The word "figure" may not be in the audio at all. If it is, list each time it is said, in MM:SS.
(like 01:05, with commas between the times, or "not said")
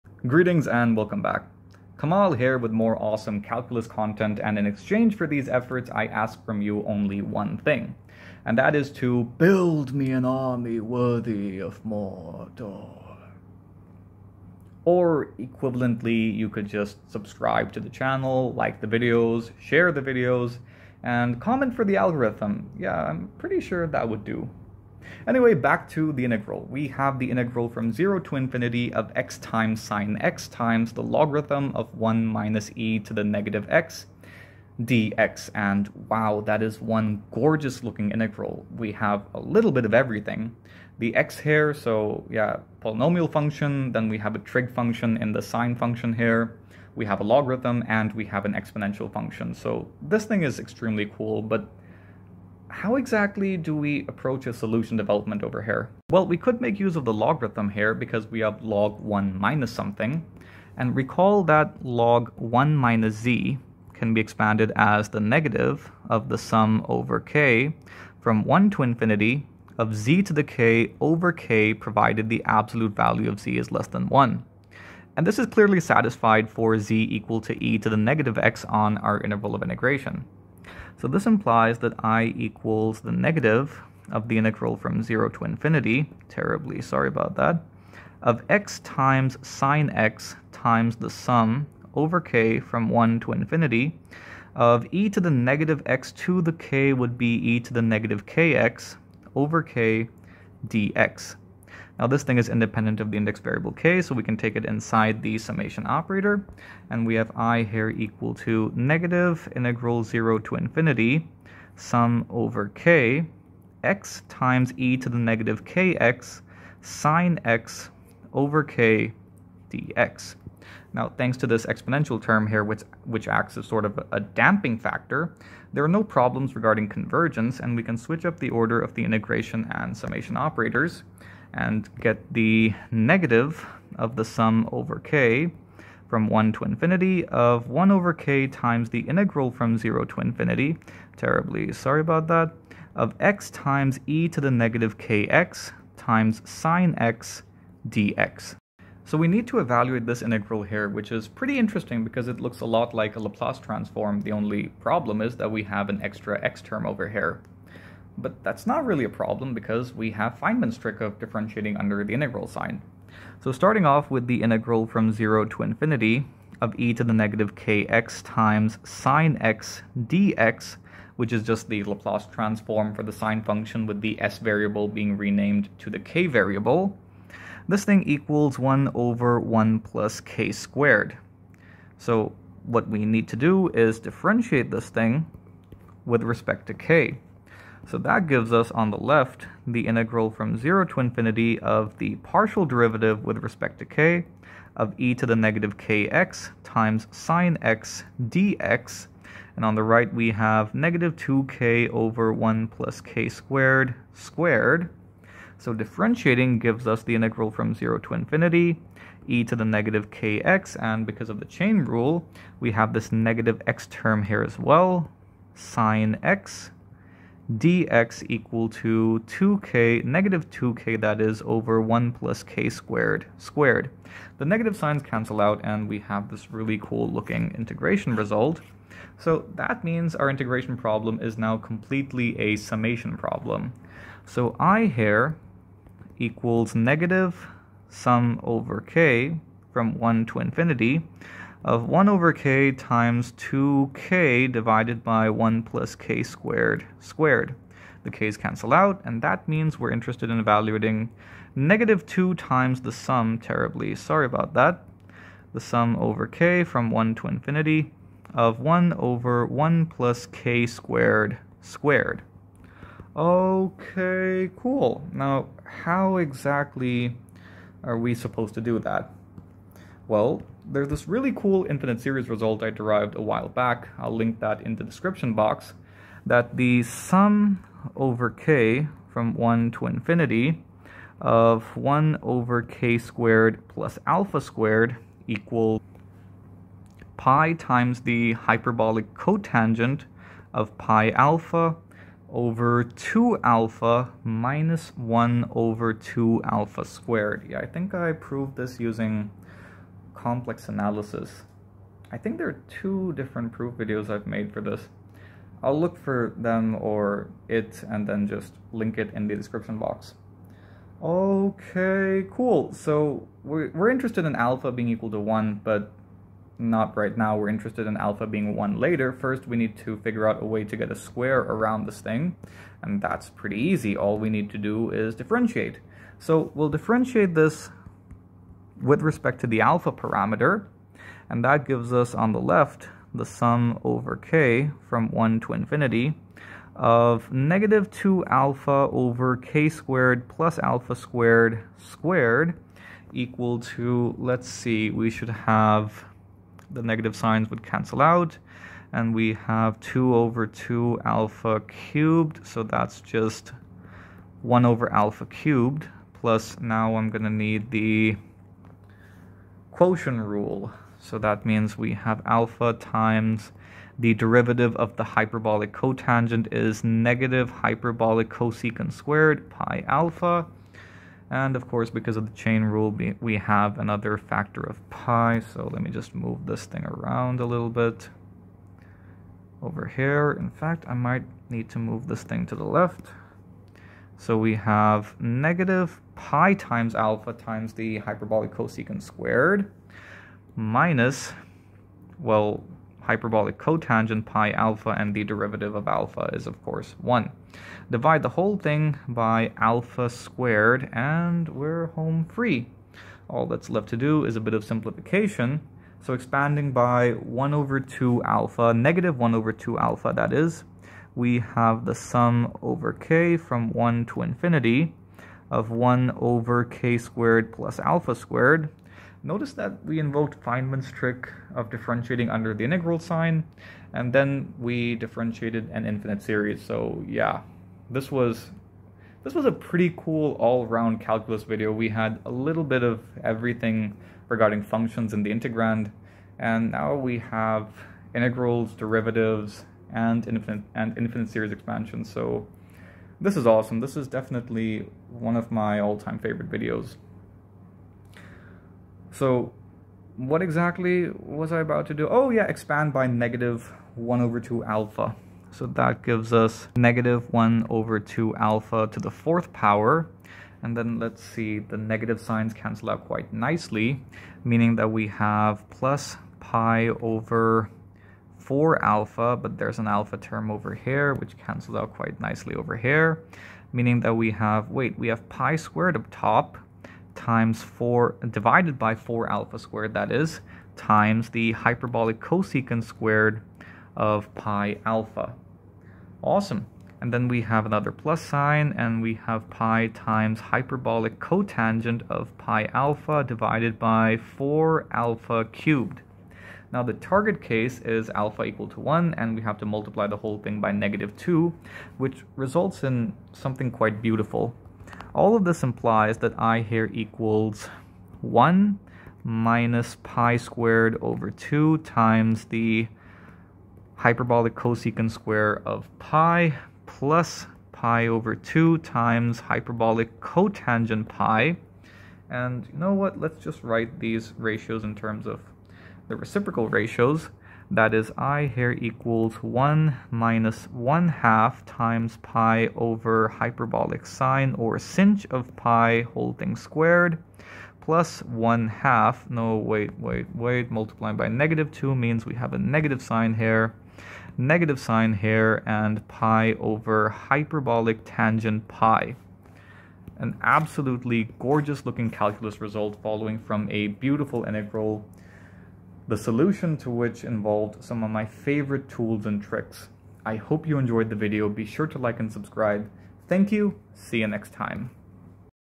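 05:19.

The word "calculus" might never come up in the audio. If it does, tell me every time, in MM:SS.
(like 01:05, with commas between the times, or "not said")
00:03, 07:11, 09:12.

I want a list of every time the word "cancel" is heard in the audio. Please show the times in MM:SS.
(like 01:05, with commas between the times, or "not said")
03:45, 04:08, 05:47, 07:42, 07:51.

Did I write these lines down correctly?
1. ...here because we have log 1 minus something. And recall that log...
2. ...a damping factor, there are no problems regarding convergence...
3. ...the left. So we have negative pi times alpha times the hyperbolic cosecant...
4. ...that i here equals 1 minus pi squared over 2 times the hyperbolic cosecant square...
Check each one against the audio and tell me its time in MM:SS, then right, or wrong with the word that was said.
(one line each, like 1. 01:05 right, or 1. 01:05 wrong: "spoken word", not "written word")
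1. 00:57 right
2. 02:04 right
3. 06:22 right
4. 08:26 right.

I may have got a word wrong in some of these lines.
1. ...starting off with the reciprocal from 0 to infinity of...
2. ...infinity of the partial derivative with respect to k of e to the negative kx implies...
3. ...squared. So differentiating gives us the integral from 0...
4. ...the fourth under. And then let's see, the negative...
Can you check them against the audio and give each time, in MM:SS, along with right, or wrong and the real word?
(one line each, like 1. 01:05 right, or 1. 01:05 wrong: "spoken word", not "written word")
1. 02:43 wrong: "integral", not "reciprocal"
2. 03:10 wrong: "times", not "implies"
3. 03:24 right
4. 07:38 wrong: "power", not "under".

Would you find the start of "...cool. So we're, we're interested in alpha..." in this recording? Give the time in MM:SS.
05:12.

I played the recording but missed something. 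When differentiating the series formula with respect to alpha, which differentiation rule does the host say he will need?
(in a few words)
quotient rule.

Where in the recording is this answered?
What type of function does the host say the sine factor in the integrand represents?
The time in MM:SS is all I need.
00:44.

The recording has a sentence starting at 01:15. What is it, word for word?
And this is clearly satisfied for z equal to e to the negative x on our interval of integration.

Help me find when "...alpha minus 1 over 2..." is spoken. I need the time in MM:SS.
04:53.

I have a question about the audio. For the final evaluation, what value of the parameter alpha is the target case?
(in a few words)
1.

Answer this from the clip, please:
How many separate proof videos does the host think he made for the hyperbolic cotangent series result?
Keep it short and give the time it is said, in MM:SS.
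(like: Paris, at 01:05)
2, at 05:02.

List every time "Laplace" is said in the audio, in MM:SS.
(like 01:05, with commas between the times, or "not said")
02:33, 02:51.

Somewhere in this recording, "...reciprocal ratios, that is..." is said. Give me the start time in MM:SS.
08:46.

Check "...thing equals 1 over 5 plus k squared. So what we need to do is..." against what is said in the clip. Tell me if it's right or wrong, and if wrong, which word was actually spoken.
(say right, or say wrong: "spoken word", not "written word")
wrong: "1", not "5".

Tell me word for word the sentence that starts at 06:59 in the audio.
Notice that we invoked Feynman's trick of differentiating under the integral sign, and then we differentiated an infinite series.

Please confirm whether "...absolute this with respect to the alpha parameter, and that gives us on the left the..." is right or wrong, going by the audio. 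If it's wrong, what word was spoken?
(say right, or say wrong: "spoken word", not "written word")
wrong: "differentiate", not "absolute".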